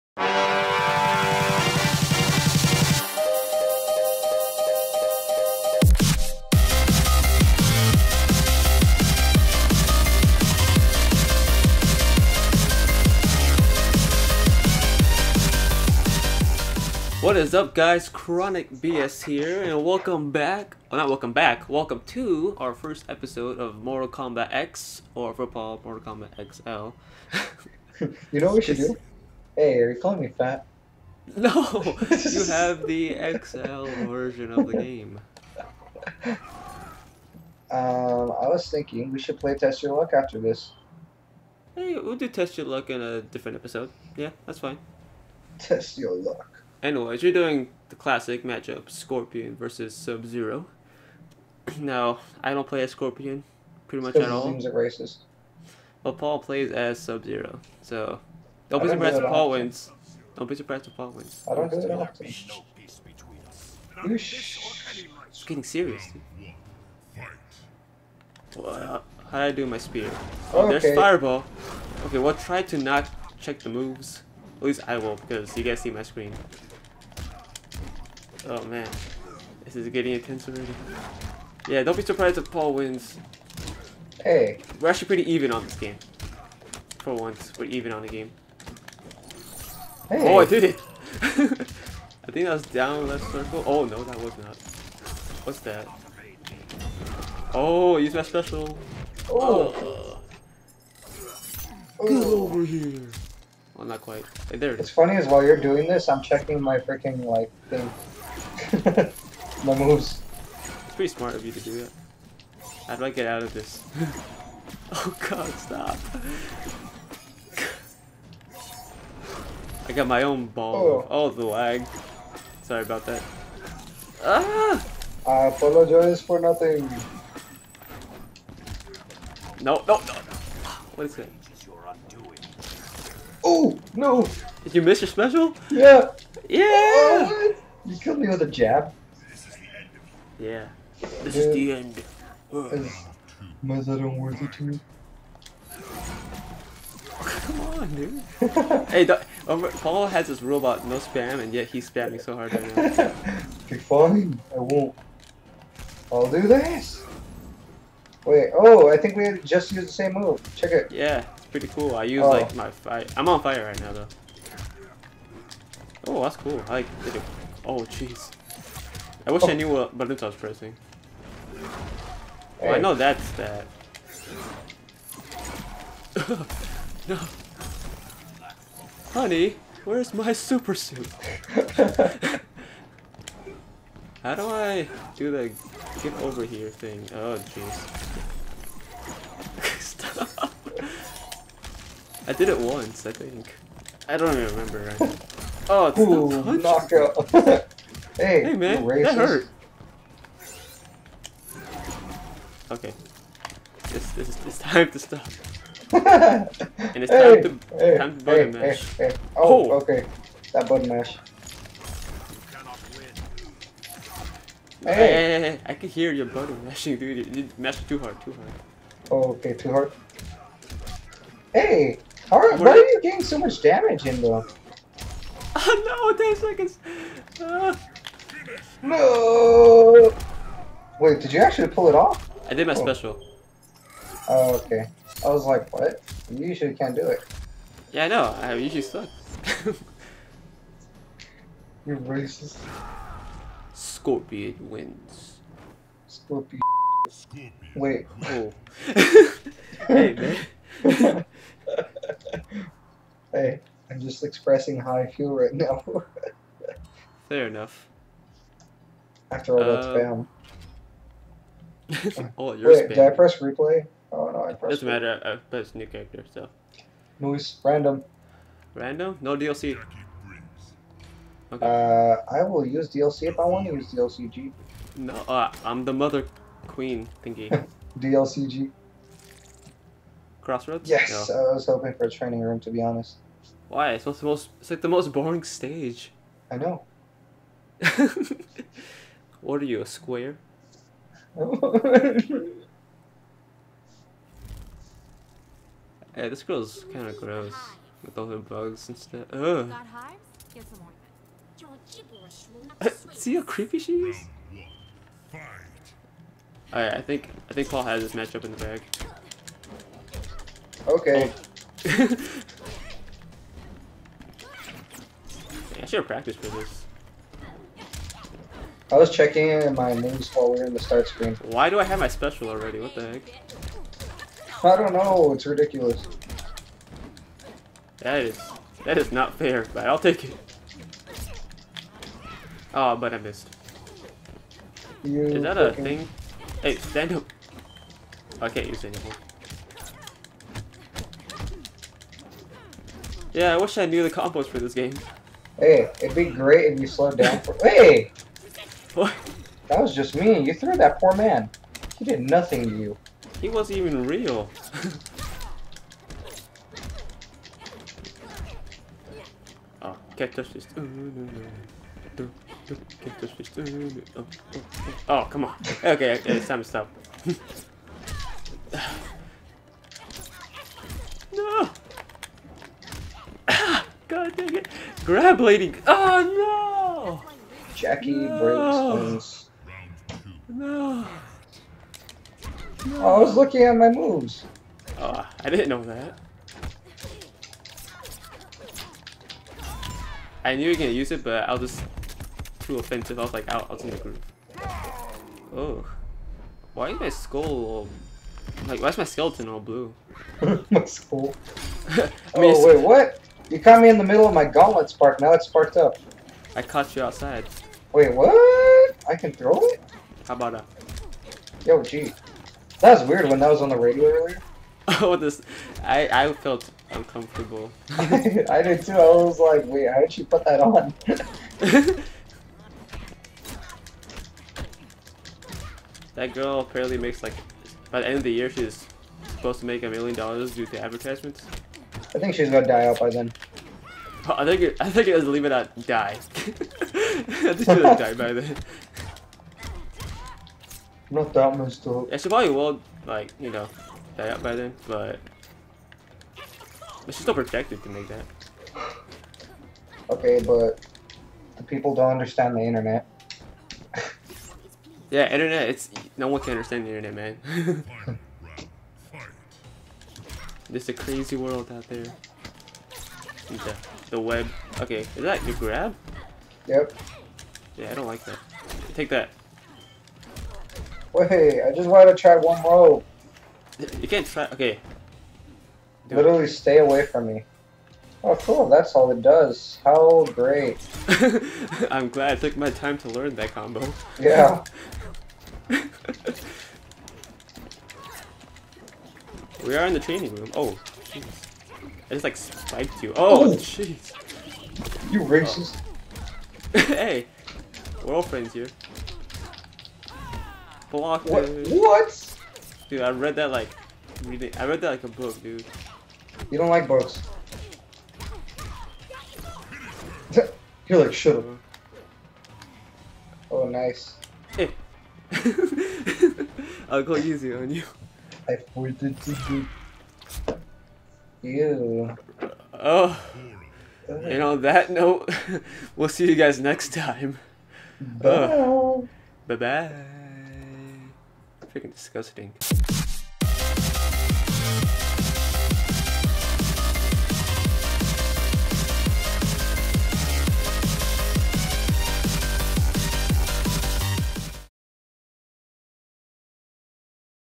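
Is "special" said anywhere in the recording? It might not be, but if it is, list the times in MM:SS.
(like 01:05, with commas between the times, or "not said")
01:38, 02:15, 03:52, 05:22.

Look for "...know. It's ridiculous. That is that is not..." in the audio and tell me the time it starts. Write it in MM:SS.
05:24.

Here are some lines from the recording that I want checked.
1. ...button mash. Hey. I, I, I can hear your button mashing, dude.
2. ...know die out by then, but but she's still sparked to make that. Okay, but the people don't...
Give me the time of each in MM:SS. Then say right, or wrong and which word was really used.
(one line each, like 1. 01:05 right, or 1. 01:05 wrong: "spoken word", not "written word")
1. 03:30 right
2. 07:23 wrong: "protected", not "sparked".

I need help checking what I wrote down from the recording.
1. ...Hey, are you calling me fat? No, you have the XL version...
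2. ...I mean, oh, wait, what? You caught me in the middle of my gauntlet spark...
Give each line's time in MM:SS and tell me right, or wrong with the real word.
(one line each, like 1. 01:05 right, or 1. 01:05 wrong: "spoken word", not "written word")
1. 00:29 right
2. 06:41 right.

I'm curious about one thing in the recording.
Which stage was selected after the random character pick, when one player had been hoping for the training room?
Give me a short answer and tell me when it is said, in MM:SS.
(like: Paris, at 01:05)
Crossroads, at 04:40.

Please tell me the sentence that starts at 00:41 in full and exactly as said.
Hey, we'll do Test Your Luck in a different episode.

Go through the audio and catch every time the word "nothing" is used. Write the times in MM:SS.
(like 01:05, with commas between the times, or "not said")
02:06, 05:52.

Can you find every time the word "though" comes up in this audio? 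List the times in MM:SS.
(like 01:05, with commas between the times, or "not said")
02:43, 07:21.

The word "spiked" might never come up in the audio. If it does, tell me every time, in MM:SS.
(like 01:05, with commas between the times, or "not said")
08:12.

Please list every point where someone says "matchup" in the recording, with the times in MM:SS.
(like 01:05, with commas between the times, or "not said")
00:48, 05:08.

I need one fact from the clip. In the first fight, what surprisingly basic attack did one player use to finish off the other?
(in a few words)
a jab.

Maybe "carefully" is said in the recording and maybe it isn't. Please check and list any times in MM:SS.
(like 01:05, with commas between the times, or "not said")
not said.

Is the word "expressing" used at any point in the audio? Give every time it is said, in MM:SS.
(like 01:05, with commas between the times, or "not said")
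04:14.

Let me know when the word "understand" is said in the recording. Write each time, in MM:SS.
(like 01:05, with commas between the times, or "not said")
07:32, 07:36.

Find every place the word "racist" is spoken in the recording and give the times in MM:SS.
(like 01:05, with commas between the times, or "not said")
00:54, 04:01, 08:15.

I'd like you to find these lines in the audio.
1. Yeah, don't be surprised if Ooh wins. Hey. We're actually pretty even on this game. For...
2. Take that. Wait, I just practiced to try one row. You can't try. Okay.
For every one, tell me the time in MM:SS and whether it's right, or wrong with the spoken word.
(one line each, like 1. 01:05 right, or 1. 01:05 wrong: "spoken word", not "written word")
1. 01:21 wrong: "Paul", not "Ooh"
2. 07:48 wrong: "wanted", not "practiced".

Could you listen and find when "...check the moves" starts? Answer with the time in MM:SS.
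01:13.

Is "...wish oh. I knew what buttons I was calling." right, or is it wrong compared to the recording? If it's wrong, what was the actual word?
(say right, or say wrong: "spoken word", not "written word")
wrong: "pressing", not "calling".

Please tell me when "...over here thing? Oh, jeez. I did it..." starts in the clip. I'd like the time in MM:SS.
03:06.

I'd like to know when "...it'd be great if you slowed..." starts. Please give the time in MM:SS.
05:46.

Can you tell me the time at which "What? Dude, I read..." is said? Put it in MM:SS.
08:21.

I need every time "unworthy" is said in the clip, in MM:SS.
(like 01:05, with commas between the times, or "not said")
02:23.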